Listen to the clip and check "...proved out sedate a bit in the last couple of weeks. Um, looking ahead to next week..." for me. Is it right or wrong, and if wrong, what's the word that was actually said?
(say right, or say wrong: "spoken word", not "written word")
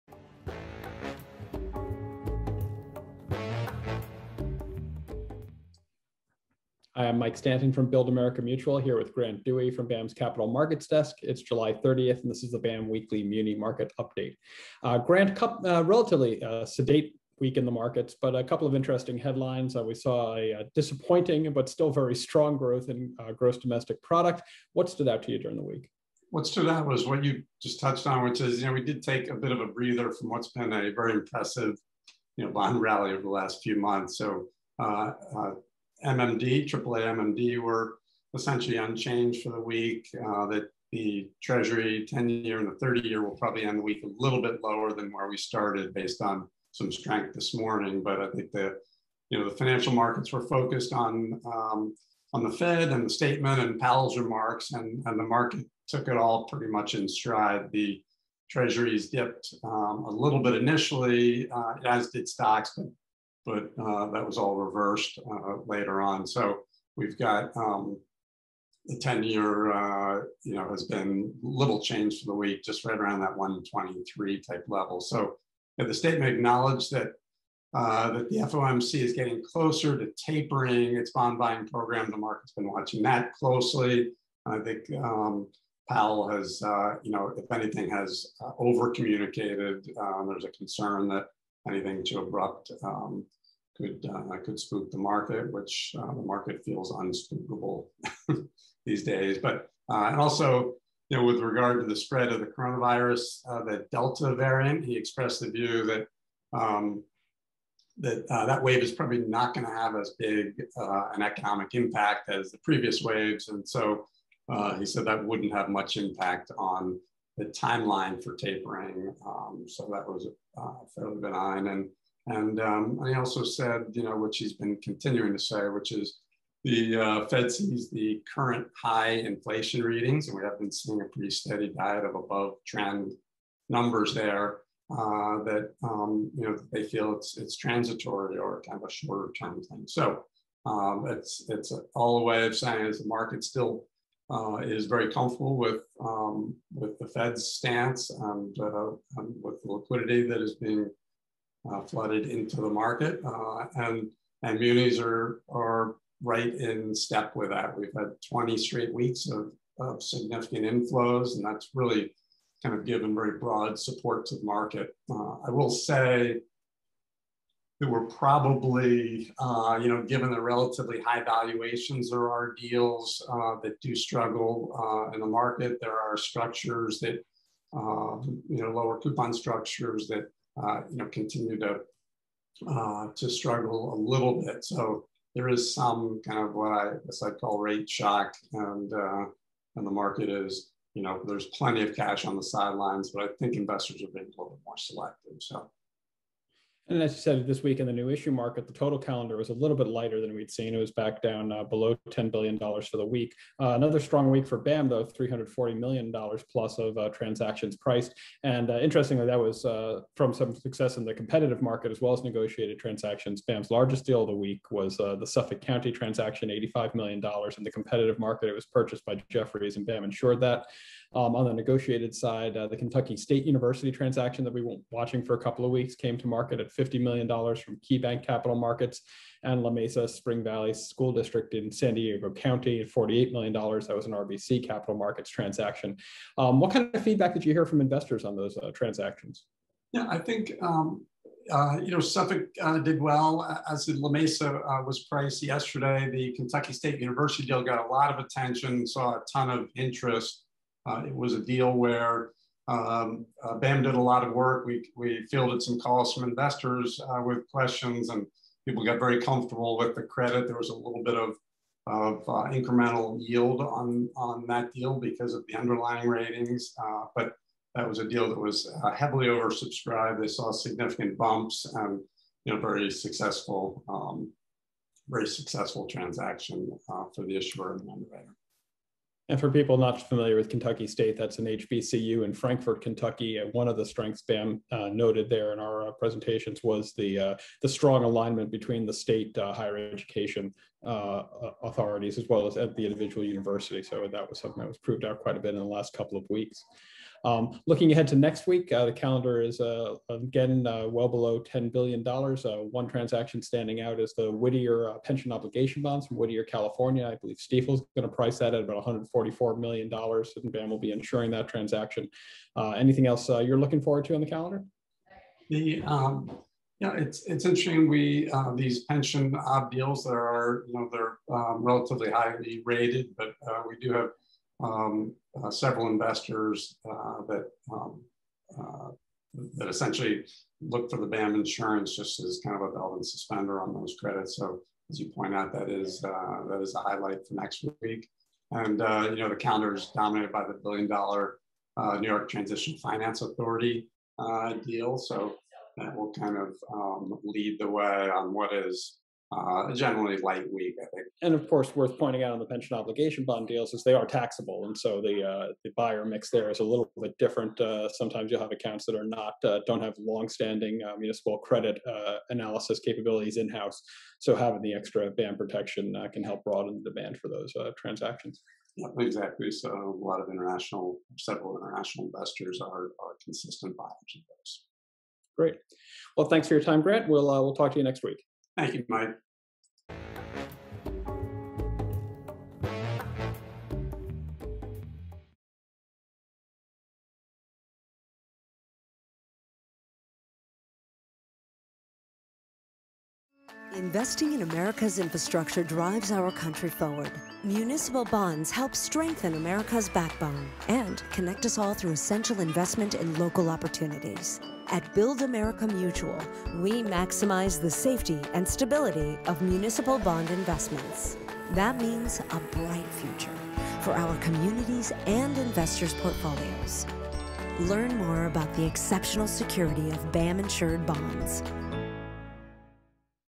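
wrong: "quite", not "sedate".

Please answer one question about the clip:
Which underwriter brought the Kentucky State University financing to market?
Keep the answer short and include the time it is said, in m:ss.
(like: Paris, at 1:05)
KeyBank Capital Markets, at 3:47.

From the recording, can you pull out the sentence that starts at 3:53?
That was an RBC Capital Markets transaction.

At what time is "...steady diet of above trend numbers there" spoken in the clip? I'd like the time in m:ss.
2:11.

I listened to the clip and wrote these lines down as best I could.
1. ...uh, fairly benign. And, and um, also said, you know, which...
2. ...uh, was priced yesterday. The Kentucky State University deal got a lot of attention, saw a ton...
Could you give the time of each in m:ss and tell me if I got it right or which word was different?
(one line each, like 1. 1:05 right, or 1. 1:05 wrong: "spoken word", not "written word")
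1. 2:00 right
2. 4:04 right.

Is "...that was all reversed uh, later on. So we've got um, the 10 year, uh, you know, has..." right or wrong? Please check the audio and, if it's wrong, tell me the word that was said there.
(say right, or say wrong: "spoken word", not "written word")
right.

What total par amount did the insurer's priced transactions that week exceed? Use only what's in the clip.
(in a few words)
$340 million.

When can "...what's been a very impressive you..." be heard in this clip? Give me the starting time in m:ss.
0:30.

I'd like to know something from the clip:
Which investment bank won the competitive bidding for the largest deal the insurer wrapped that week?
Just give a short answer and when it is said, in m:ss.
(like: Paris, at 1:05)
Jefferies, at 3:39.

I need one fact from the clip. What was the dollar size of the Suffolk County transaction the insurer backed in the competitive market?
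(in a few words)
$85 million.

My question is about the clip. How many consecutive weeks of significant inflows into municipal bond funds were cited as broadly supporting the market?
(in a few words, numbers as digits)
20.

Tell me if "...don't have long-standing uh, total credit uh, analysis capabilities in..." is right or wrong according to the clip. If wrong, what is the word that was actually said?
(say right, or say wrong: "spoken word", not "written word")
wrong: "municipal", not "total".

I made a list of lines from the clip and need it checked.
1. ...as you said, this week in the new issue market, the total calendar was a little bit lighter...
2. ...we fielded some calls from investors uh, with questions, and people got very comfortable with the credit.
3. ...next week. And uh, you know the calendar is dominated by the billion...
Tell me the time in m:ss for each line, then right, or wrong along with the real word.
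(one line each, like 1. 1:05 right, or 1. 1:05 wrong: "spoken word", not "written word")
1. 3:17 right
2. 4:14 right
3. 5:37 right.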